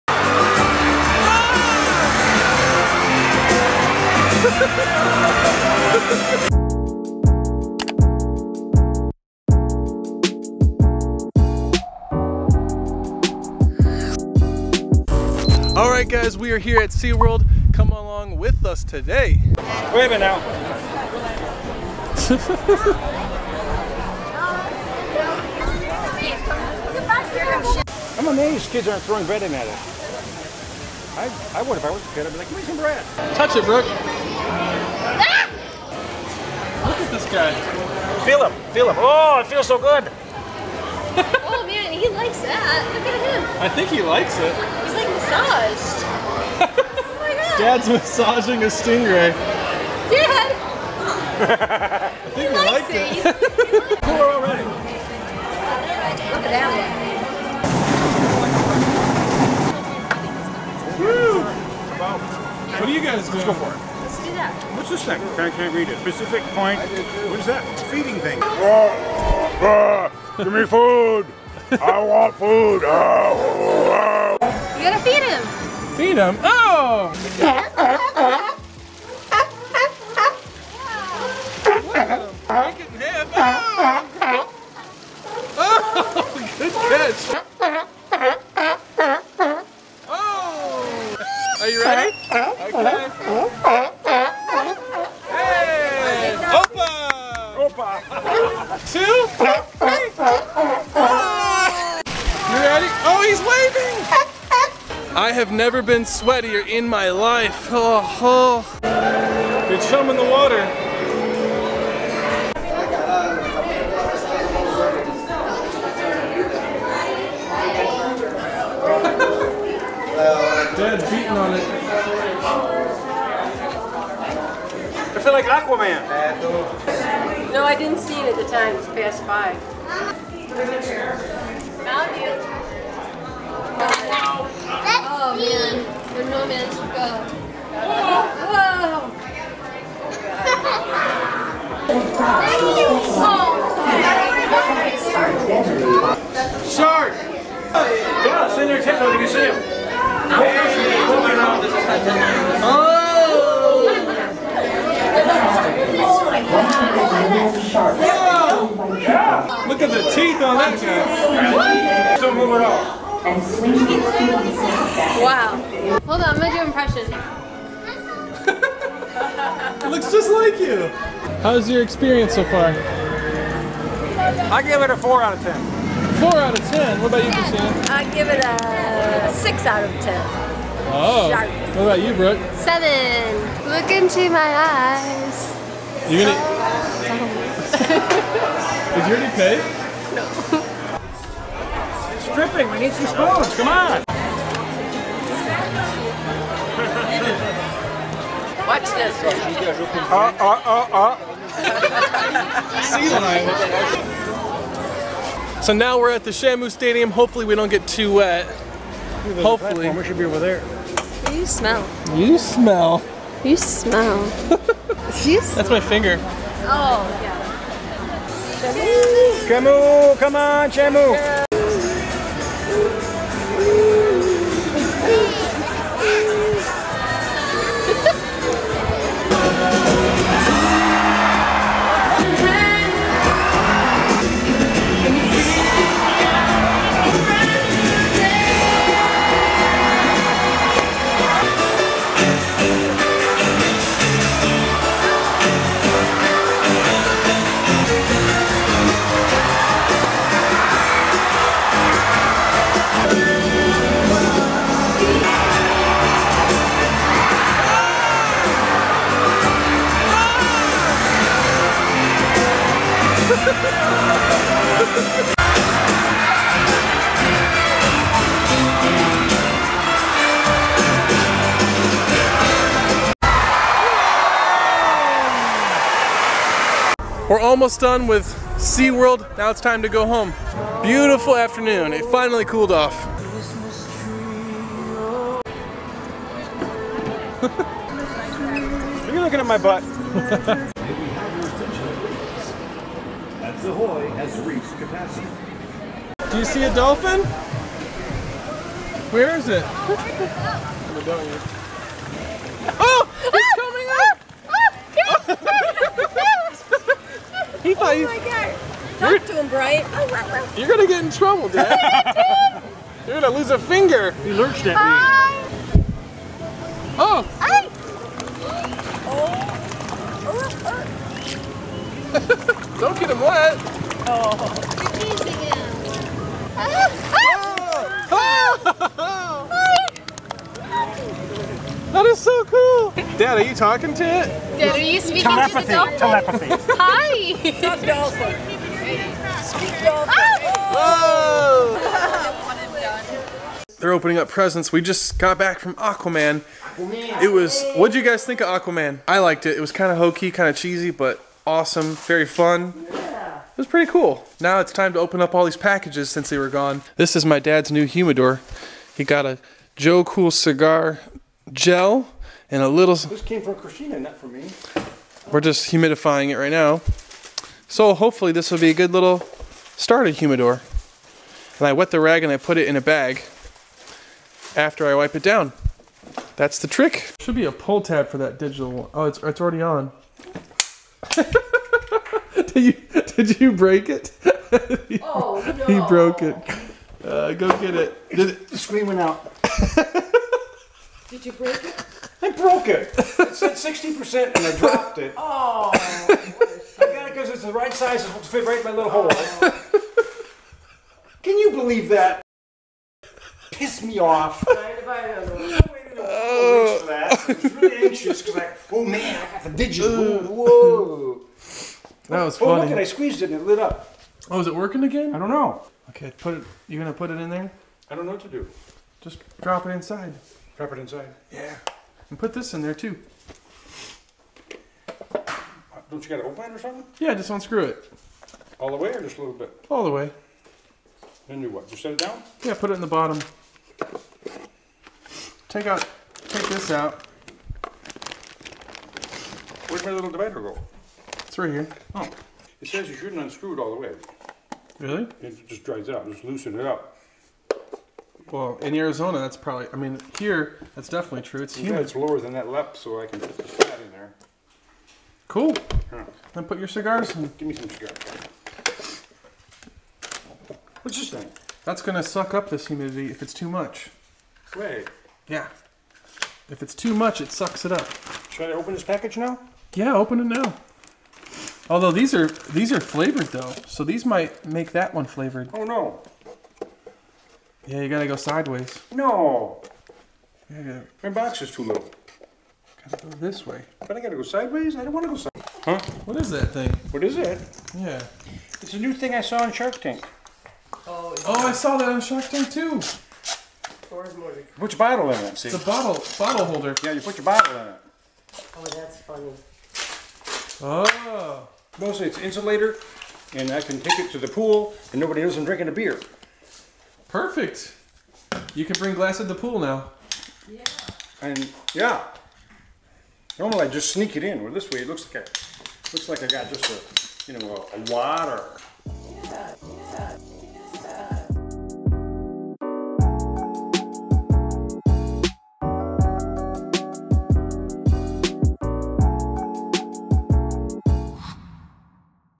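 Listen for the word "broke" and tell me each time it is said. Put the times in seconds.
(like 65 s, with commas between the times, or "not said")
385 s, 392 s.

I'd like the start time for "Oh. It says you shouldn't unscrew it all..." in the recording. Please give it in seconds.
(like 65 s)
441 s.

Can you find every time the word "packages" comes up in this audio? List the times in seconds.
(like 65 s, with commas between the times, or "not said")
355 s, 468 s.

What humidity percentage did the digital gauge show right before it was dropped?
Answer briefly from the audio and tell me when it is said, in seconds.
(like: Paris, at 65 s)
60%, at 393 s.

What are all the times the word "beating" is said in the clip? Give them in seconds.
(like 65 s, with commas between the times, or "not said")
121 s.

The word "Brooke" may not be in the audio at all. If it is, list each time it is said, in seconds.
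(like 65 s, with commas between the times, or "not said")
33 s, 182 s.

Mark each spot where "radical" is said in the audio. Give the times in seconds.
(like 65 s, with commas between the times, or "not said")
not said.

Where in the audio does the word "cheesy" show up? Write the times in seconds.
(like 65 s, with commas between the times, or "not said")
350 s.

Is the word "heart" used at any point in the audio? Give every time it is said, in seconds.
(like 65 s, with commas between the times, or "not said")
not said.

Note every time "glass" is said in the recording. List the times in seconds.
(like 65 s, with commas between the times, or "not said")
508 s.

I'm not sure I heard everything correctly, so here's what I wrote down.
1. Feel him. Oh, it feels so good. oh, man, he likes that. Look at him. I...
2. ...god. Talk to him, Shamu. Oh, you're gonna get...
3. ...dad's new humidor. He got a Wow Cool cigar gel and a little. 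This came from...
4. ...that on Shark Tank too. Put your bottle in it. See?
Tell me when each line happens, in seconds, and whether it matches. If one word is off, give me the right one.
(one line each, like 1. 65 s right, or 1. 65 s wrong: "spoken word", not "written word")
1. 38 s right
2. 308 s wrong: "Brian", not "Shamu"
3. 357 s wrong: "Joe", not "Wow"
4. 491 s right.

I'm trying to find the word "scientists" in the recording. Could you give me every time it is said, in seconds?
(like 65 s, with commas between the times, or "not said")
not said.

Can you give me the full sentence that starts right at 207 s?
Hopefully we don't get too wet.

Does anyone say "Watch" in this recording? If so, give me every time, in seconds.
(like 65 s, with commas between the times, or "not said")
198 s.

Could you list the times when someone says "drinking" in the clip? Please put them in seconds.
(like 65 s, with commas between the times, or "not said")
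505 s.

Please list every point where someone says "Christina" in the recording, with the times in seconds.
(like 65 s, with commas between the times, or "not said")
177 s, 363 s.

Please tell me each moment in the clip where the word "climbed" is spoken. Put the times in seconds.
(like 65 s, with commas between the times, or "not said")
not said.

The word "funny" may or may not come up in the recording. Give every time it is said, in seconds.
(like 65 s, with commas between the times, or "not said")
412 s, 498 s.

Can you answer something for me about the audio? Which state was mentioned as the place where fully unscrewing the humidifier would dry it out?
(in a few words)
Arizona.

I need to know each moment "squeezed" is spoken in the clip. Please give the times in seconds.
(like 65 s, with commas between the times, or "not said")
412 s.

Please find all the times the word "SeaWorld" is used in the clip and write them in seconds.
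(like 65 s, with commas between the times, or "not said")
16 s, 278 s.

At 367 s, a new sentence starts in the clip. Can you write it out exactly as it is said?
So hopefully this will be a good little starter humidor.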